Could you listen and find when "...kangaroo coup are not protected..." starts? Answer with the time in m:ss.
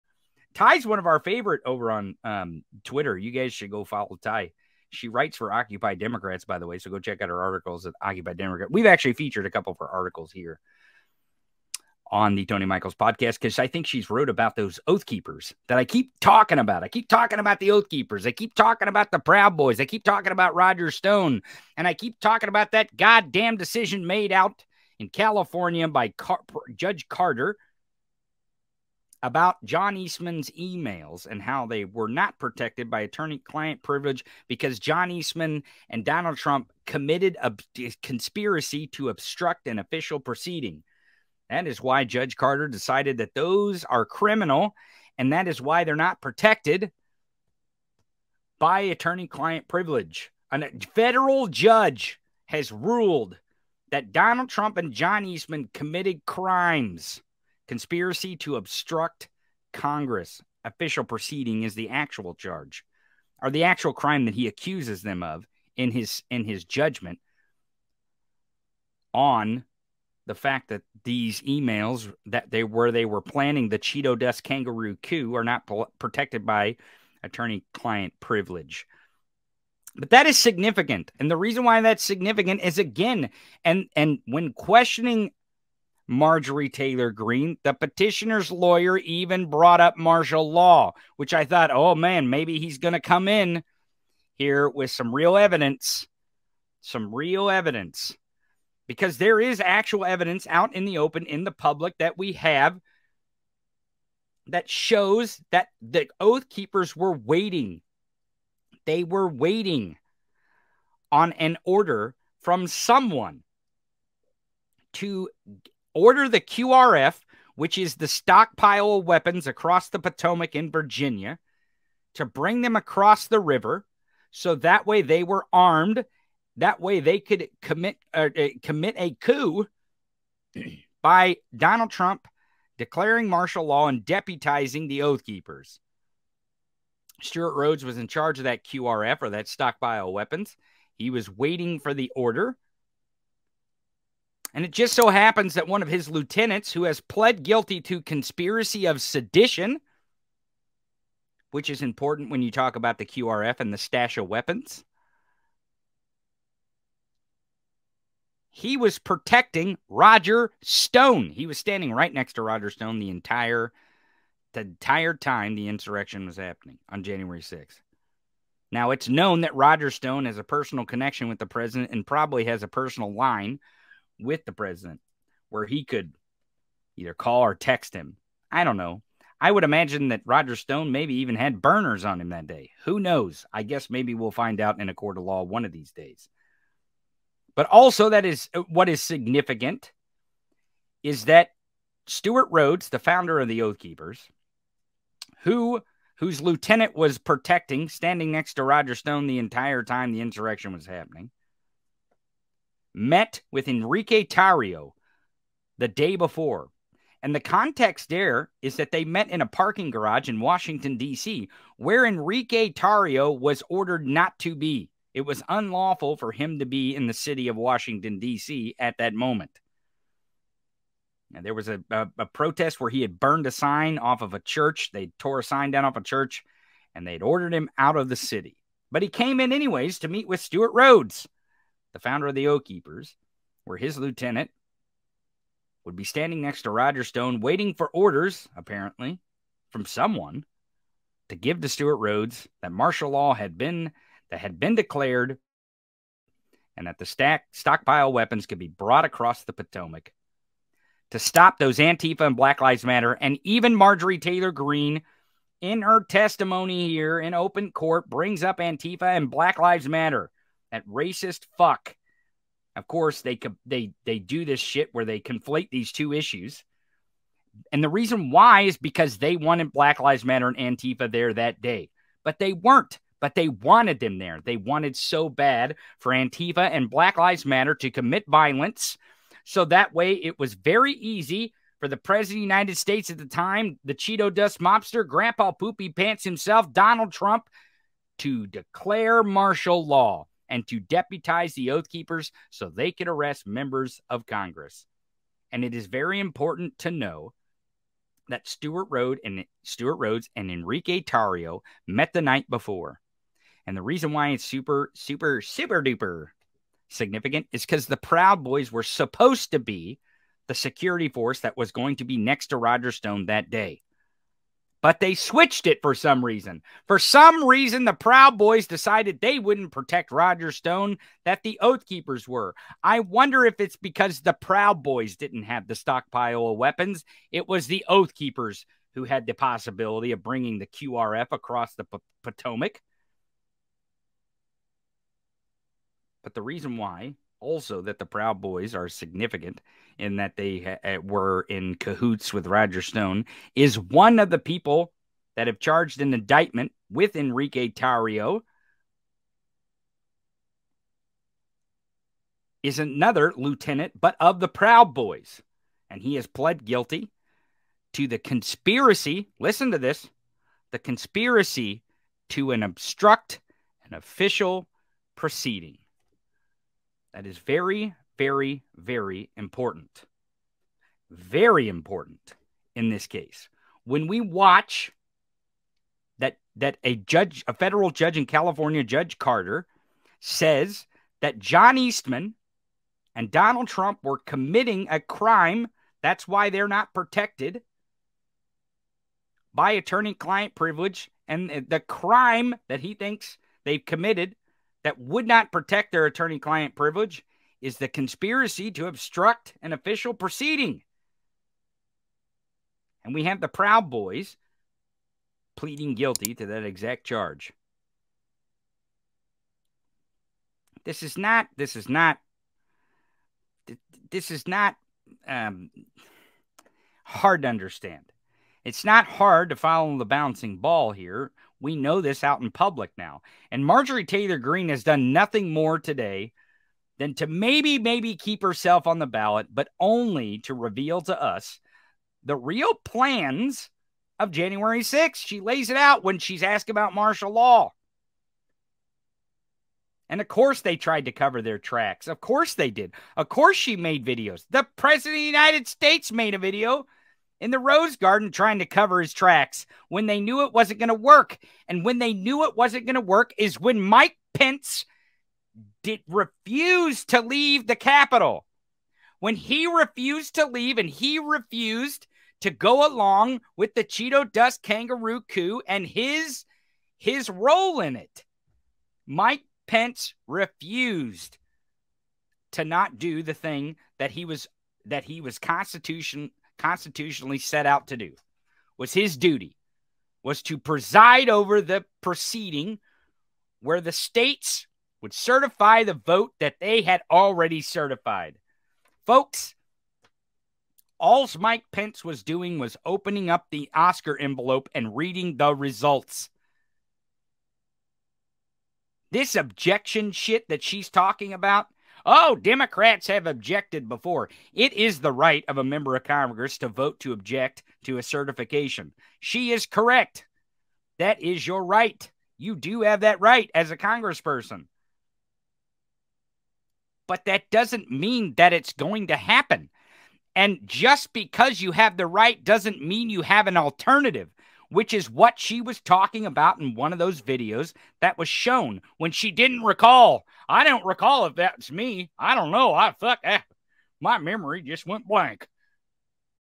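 1:14.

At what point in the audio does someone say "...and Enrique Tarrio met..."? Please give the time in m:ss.
5:00.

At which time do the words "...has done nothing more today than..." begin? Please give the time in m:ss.
7:04.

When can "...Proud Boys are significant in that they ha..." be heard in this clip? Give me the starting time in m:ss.
5:38.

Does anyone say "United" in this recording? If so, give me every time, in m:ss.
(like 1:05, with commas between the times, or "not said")
4:42, 7:25.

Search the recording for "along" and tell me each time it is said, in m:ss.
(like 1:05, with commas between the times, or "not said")
7:42.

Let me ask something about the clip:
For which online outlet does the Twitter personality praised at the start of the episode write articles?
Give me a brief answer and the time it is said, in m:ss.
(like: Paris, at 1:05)
Occupy Democrats, at 0:05.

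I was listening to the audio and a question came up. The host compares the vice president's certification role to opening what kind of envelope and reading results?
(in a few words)
Oscar envelope.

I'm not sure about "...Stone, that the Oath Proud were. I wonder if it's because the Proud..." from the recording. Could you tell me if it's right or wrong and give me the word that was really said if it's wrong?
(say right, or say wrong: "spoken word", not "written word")
wrong: "Keepers", not "Proud".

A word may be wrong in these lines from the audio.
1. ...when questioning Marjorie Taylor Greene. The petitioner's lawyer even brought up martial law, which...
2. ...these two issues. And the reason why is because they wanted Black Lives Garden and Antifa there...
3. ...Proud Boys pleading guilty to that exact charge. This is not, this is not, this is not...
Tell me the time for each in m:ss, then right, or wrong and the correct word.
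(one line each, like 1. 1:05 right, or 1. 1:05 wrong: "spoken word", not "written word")
1. 1:24 right
2. 4:25 wrong: "Matter", not "Garden"
3. 6:43 right.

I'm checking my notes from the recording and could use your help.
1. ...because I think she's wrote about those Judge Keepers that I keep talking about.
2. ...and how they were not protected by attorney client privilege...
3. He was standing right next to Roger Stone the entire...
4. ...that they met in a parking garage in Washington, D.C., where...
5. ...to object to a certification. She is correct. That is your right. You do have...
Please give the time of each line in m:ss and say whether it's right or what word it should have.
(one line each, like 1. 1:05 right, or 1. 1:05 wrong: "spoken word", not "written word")
1. 0:13 wrong: "Oath", not "Judge"
2. 0:31 right
3. 2:41 right
4. 3:28 right
5. 8:27 right.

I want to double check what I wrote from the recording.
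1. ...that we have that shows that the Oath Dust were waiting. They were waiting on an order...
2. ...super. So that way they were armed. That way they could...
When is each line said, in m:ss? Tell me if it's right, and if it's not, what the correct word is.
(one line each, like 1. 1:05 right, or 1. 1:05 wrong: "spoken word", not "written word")
1. 1:41 wrong: "Keepers", not "Dust"
2. 2:03 wrong: "river", not "super".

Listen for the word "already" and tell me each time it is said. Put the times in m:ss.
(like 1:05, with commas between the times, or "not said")
8:07.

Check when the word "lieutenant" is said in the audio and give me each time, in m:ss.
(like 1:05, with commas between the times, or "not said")
2:26, 3:16, 3:53, 5:53.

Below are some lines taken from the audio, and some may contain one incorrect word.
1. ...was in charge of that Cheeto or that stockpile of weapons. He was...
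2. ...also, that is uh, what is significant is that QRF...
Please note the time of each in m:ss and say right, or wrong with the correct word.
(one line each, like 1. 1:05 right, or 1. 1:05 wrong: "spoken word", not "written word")
1. 2:17 wrong: "QRF", not "Cheeto"
2. 3:07 wrong: "Stewart", not "QRF".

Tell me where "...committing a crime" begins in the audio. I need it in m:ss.
6:24.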